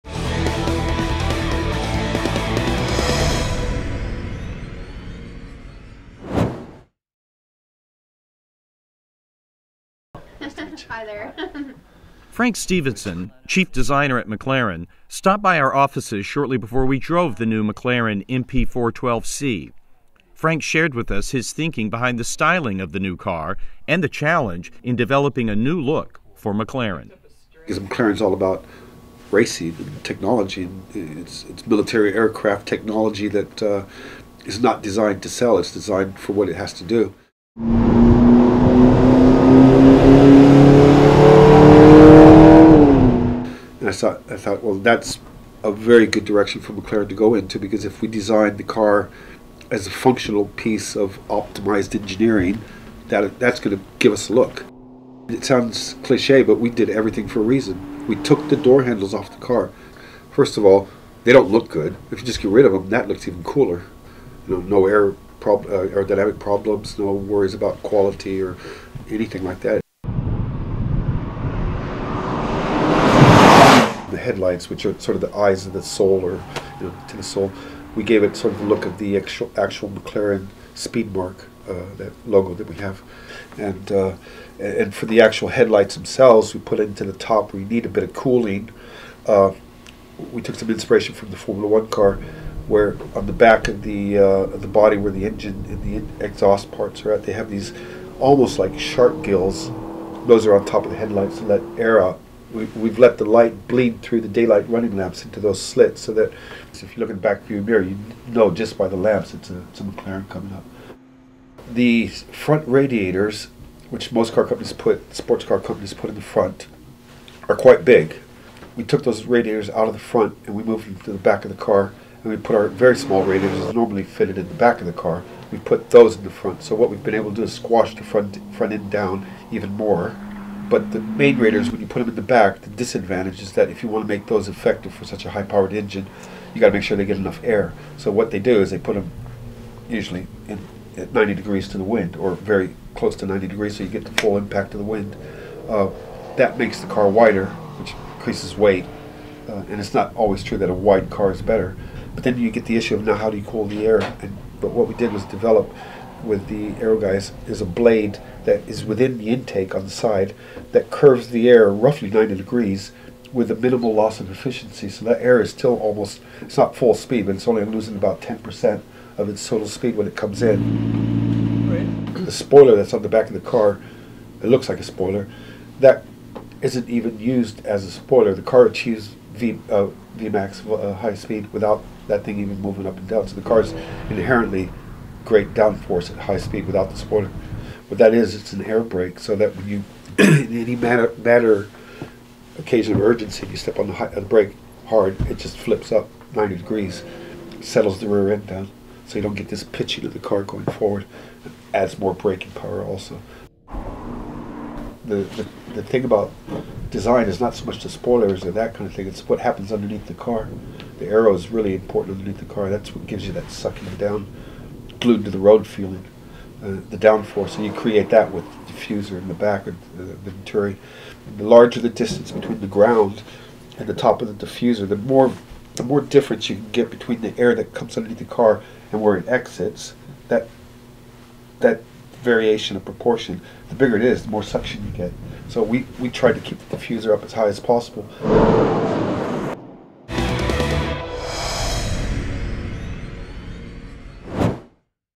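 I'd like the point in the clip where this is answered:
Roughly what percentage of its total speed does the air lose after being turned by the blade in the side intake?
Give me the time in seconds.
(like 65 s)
168 s.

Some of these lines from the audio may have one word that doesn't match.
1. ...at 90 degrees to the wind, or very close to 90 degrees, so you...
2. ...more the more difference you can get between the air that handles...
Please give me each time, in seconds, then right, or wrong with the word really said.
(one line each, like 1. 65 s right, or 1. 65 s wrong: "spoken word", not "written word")
1. 140 s right
2. 224 s wrong: "comes", not "handles".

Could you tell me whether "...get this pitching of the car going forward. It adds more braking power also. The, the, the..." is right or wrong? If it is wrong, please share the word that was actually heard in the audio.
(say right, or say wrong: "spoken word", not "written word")
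right.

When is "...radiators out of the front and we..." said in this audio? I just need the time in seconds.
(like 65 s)
119 s.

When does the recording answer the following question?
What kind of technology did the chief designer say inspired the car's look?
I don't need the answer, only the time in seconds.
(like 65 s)
31 s.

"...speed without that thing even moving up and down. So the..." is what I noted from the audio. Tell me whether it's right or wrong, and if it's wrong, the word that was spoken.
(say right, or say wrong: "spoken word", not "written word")
right.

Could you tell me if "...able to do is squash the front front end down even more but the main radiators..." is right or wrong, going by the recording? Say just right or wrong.
wrong.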